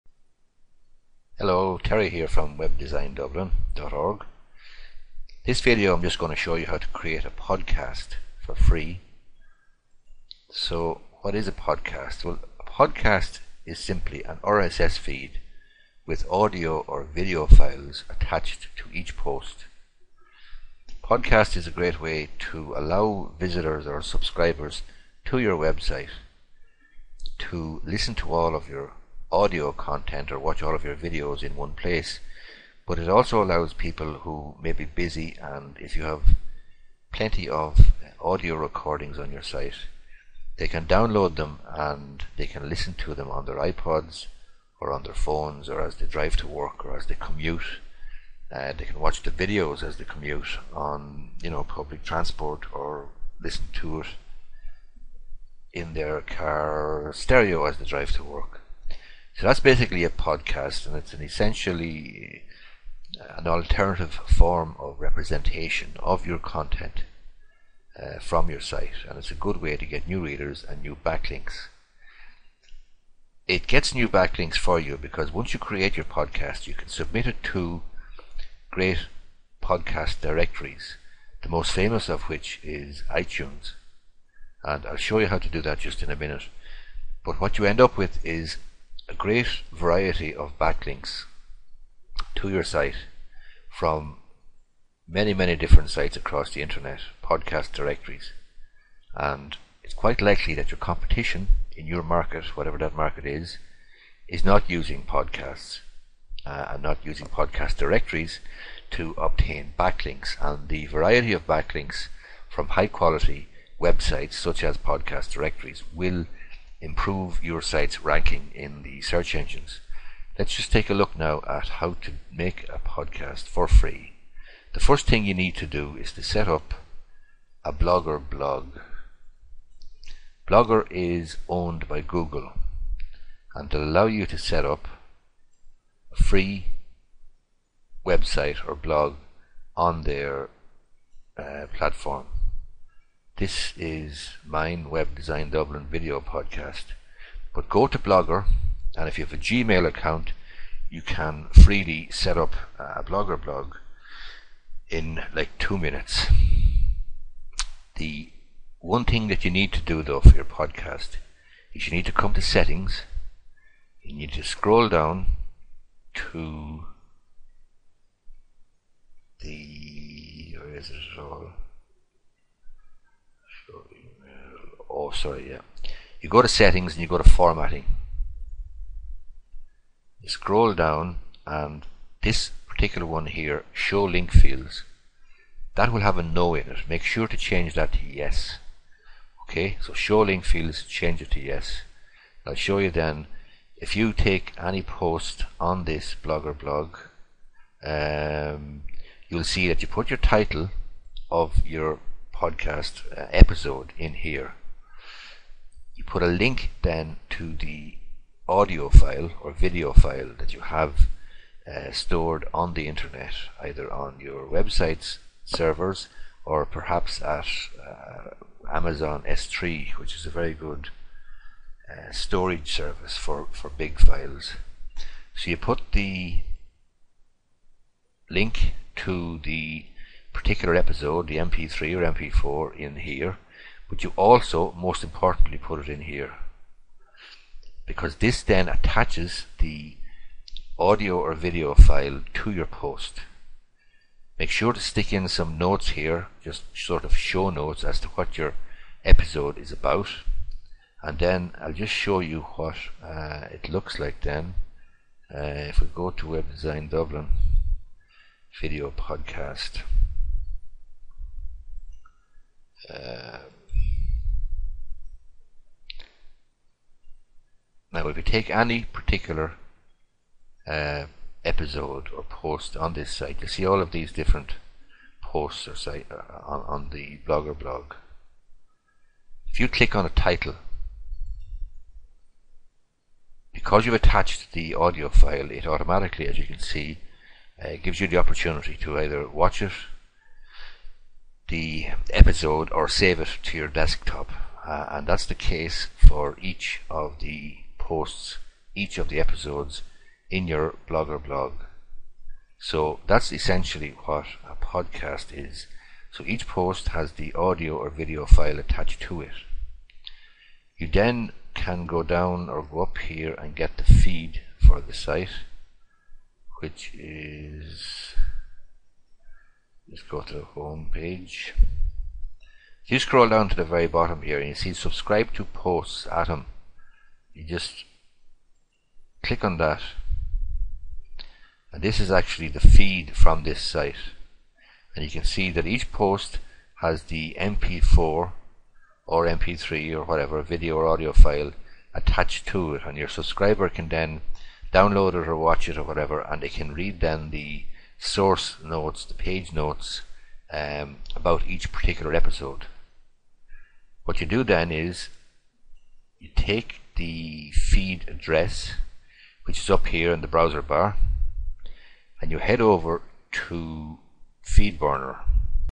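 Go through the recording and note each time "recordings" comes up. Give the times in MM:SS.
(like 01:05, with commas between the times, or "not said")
00:38.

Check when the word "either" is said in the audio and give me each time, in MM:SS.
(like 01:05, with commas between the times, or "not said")
03:33, 04:48.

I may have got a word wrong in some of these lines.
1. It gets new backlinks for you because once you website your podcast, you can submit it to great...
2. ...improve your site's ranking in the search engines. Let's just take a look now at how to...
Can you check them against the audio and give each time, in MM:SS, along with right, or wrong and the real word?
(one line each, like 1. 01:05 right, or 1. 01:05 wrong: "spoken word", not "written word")
1. 01:13 wrong: "create", not "website"
2. 01:56 right.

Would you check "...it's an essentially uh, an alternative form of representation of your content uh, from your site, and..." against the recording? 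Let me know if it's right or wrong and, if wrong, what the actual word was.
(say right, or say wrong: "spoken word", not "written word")
right.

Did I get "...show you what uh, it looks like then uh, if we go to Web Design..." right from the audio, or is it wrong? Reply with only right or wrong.
right.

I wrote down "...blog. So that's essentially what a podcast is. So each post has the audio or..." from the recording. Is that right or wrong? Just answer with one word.
right.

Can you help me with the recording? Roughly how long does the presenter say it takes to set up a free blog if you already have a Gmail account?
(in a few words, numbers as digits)
2 minutes.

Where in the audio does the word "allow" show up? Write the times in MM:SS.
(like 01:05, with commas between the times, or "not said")
00:22, 00:33, 02:13.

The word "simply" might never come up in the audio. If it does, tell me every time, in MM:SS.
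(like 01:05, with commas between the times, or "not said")
00:13.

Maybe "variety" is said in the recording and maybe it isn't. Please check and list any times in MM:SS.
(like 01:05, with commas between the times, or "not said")
01:29, 01:50.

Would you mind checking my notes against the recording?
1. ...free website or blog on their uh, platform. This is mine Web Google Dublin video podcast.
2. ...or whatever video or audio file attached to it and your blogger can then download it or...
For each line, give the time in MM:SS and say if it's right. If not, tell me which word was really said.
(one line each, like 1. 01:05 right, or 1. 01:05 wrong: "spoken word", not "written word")
1. 02:16 wrong: "Design", not "Google"
2. 05:39 wrong: "subscriber", not "blogger".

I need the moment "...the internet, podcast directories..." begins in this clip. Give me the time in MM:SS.
01:36.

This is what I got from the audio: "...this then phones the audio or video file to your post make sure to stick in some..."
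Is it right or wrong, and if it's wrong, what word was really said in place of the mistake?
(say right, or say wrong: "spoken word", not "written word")
wrong: "attaches", not "phones".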